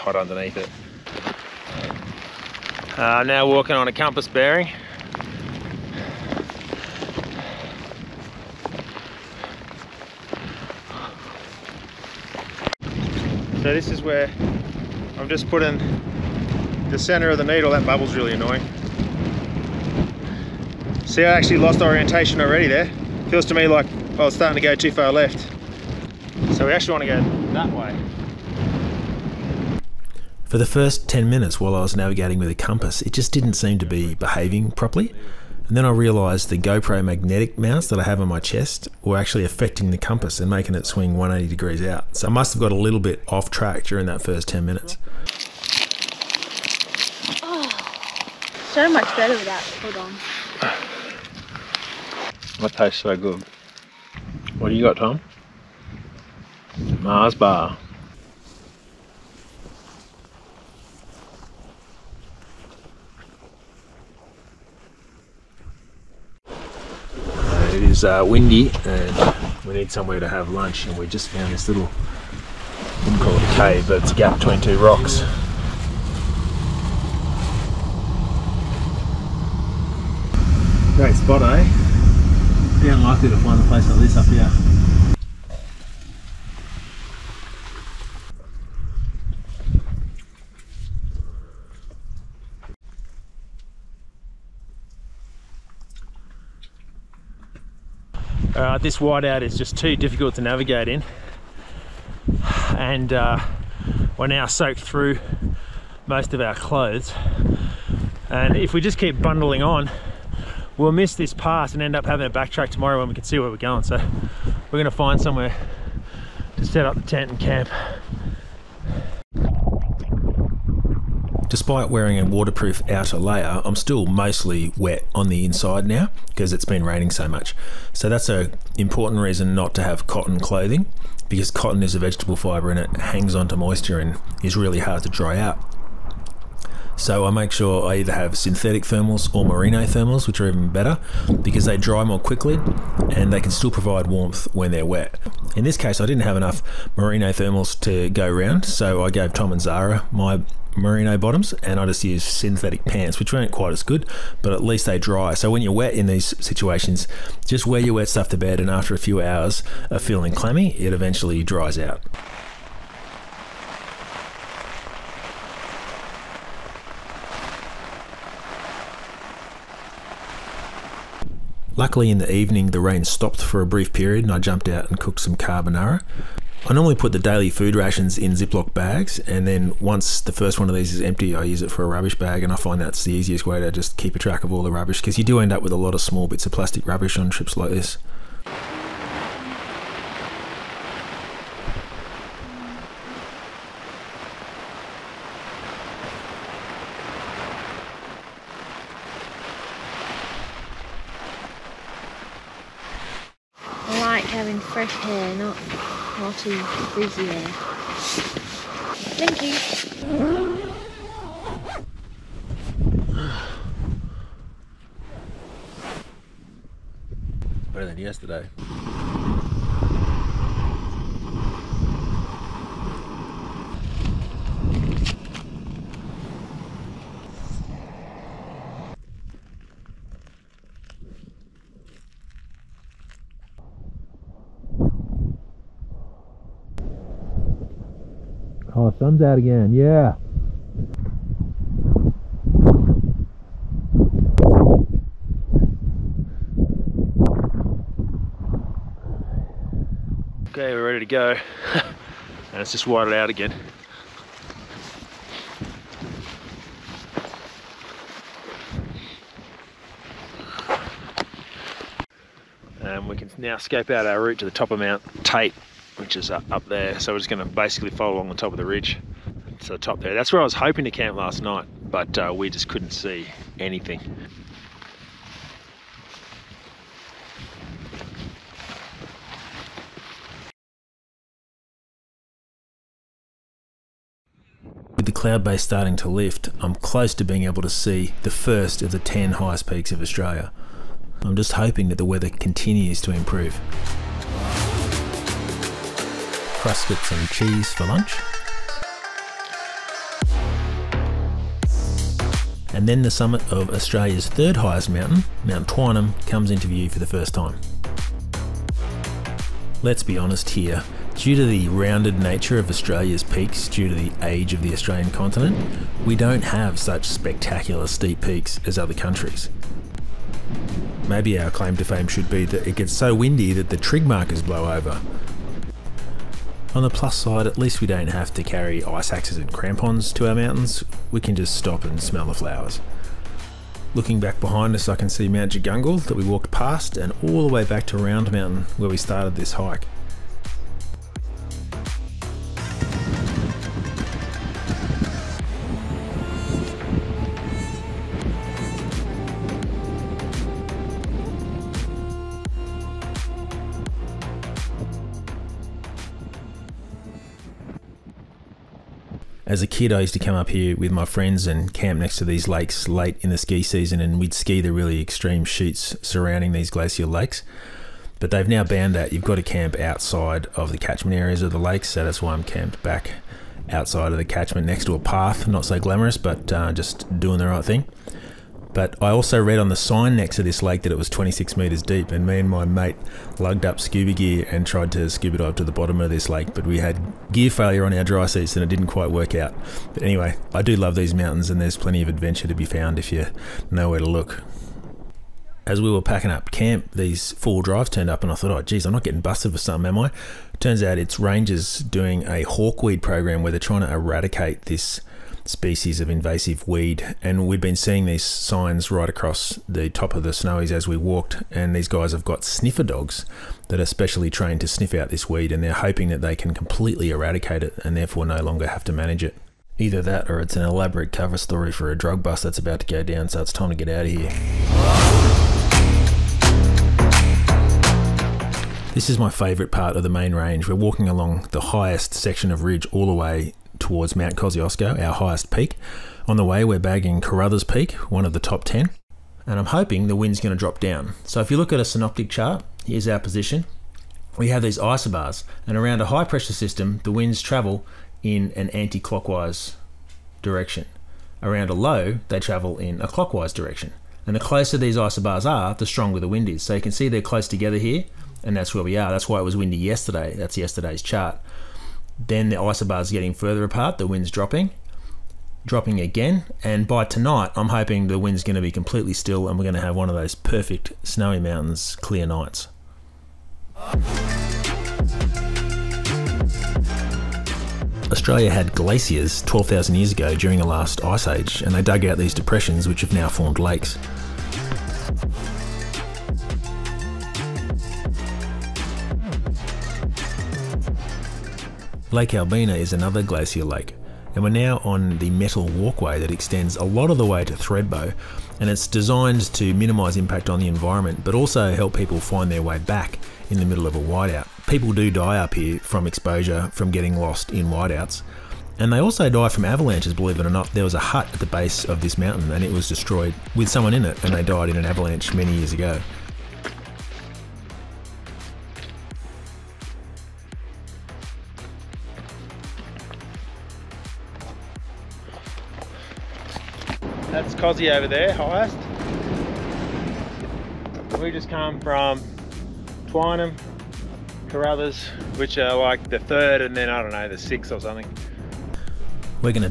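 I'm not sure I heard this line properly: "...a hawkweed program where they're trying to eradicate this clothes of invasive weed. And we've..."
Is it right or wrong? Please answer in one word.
wrong.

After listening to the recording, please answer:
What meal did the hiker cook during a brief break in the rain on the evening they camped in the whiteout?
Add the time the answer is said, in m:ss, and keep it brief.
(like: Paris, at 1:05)
Carbonara, at 2:55.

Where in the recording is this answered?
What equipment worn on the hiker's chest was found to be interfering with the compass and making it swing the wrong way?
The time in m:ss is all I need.
0:36.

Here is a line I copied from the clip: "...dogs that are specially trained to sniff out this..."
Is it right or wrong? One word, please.
right.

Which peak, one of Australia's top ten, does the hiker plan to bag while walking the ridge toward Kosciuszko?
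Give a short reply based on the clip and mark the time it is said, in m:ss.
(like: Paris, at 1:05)
Carruthers Peak, at 7:17.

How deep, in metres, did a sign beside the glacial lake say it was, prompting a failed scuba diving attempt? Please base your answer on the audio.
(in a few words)
26 metres.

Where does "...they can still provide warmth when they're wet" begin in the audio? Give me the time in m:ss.
2:23.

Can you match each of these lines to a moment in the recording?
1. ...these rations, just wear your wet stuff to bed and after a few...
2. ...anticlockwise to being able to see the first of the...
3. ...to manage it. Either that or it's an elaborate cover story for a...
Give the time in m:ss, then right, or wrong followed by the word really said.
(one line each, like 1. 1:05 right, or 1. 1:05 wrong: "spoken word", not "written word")
1. 2:36 wrong: "situations", not "rations"
2. 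4:46 wrong: "close", not "anticlockwise"
3. 6:58 right.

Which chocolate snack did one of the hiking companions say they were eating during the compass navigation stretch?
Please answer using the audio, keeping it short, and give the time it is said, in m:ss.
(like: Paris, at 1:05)
Mars bar, at 0:57.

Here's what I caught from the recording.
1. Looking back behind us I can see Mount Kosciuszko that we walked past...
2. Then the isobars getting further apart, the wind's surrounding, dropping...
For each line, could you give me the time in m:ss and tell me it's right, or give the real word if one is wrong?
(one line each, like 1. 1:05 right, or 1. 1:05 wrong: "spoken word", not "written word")
1. 5:33 wrong: "Jagungal", not "Kosciuszko"
2. 7:42 wrong: "dropping", not "surrounding".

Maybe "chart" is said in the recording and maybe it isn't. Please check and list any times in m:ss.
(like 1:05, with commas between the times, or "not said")
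7:22, 7:41.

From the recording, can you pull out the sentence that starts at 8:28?
And they also die from avalanches, believe it or not.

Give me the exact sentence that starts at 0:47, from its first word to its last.
Oh, so much better without Hold on.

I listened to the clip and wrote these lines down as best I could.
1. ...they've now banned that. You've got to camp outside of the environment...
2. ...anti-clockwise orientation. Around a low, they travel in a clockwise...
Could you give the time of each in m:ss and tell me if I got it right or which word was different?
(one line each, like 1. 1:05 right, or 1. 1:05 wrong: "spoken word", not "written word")
1. 6:08 wrong: "catchment", not "environment"
2. 7:28 wrong: "direction", not "orientation".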